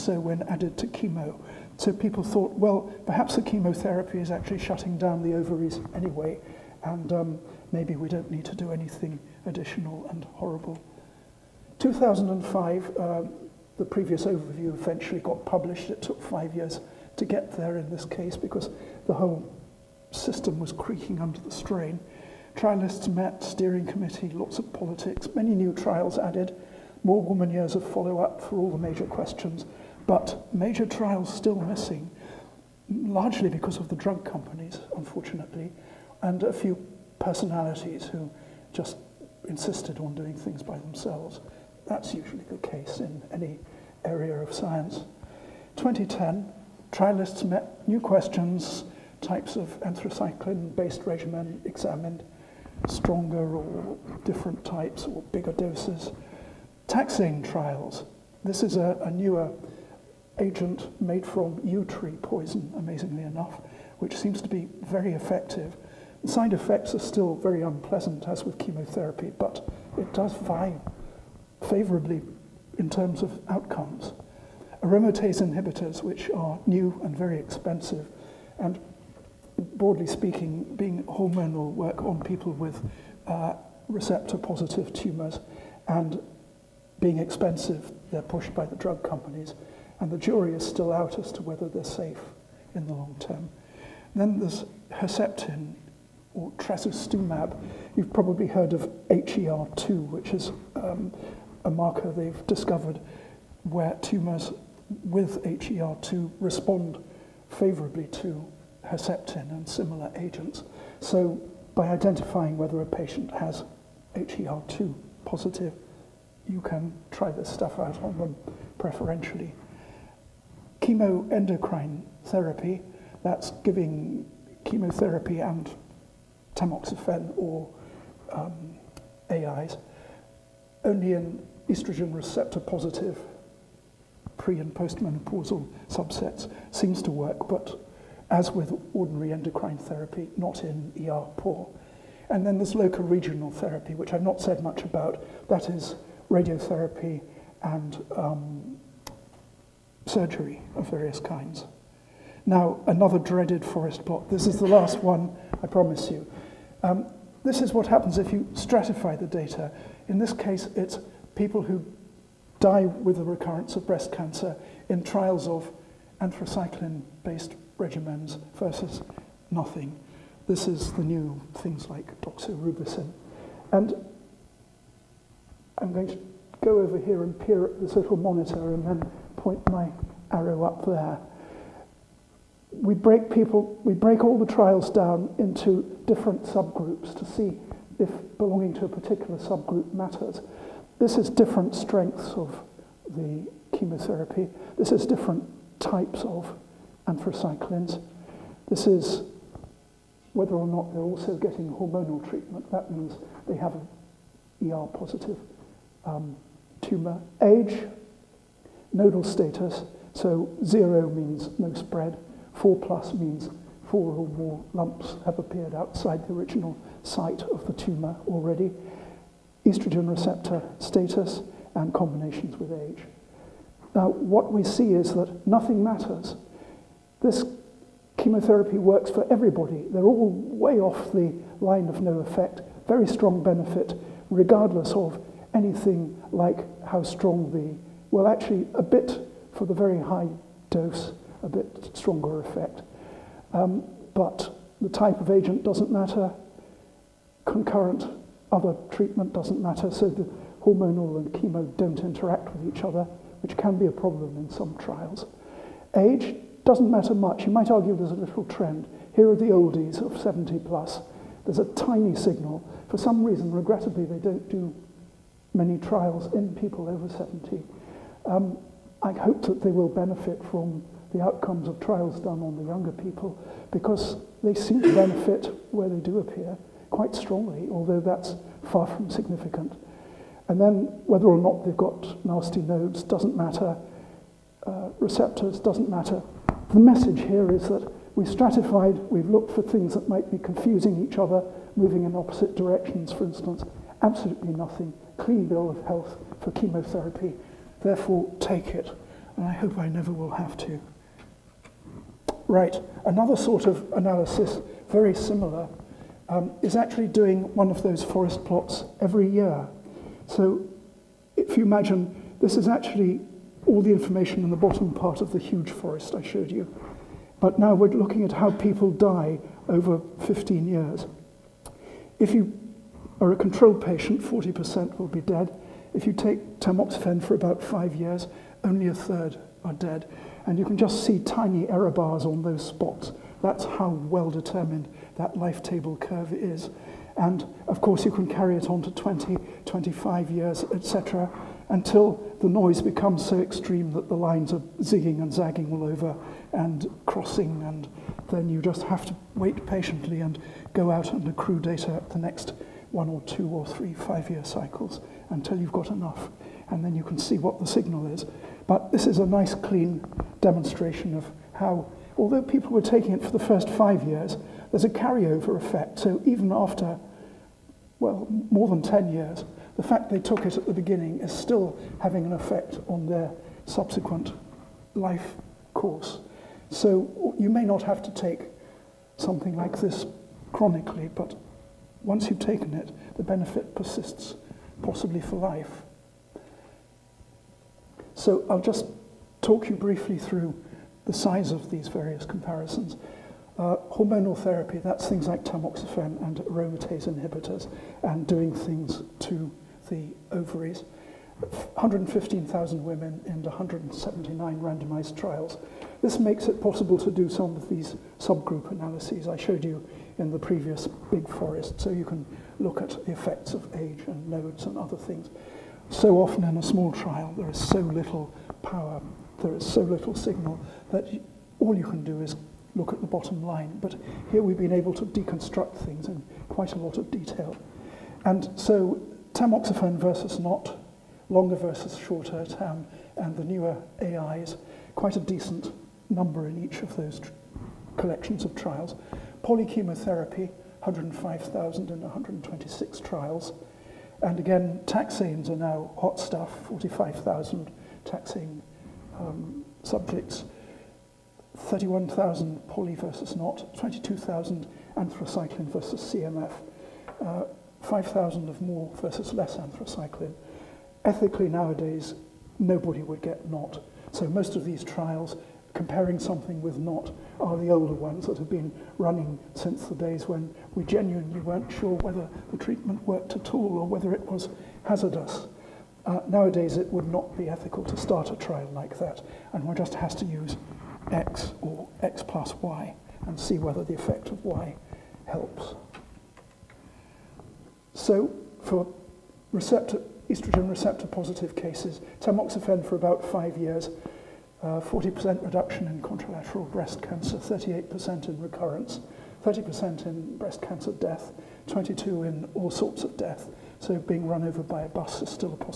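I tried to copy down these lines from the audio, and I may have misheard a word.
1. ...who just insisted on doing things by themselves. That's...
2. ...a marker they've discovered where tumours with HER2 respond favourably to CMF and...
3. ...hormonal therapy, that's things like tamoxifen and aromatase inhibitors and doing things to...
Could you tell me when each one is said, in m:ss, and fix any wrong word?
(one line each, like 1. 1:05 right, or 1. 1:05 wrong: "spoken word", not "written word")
1. 0:38 right
2. 1:41 wrong: "Herceptin", not "CMF"
3. 6:33 right.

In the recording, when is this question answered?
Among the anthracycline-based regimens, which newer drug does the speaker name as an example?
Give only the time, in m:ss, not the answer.
2:52.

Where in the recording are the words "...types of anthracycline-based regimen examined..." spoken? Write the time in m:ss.
0:49.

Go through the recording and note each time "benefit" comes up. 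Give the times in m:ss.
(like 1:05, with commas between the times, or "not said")
3:53, 4:29, 4:34, 6:23.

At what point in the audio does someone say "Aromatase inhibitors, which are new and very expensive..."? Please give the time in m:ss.
1:14.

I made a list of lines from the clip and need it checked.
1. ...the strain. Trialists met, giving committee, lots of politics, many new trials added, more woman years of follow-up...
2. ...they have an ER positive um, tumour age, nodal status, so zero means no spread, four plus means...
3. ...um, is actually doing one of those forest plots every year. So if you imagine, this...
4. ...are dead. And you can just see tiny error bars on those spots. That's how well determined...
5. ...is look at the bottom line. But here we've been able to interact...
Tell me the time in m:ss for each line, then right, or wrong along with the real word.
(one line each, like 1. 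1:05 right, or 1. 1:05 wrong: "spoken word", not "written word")
1. 0:21 wrong: "steering", not "giving"
2. 3:23 right
3. 5:06 right
4. 5:29 right
5. 7:02 wrong: "deconstruct", not "interact".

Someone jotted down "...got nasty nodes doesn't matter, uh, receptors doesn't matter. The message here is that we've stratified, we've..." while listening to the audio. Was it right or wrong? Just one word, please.
right.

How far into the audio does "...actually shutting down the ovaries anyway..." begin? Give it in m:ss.
0:04.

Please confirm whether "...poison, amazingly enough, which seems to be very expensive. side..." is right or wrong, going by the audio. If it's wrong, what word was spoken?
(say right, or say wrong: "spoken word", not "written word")
wrong: "effective", not "expensive".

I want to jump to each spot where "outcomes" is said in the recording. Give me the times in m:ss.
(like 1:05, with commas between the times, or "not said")
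1:13, 4:31.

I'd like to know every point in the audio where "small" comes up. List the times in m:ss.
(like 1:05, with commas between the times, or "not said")
6:56.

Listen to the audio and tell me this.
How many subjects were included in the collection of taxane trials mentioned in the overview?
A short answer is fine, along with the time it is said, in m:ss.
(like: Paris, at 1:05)
45,000, at 7:26.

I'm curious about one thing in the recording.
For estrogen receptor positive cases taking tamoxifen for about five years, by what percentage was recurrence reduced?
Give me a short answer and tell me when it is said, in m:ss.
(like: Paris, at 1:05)
38%, at 8:17.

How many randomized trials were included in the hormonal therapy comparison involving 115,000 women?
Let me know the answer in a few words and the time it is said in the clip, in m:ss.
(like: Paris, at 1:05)
179, at 6:43.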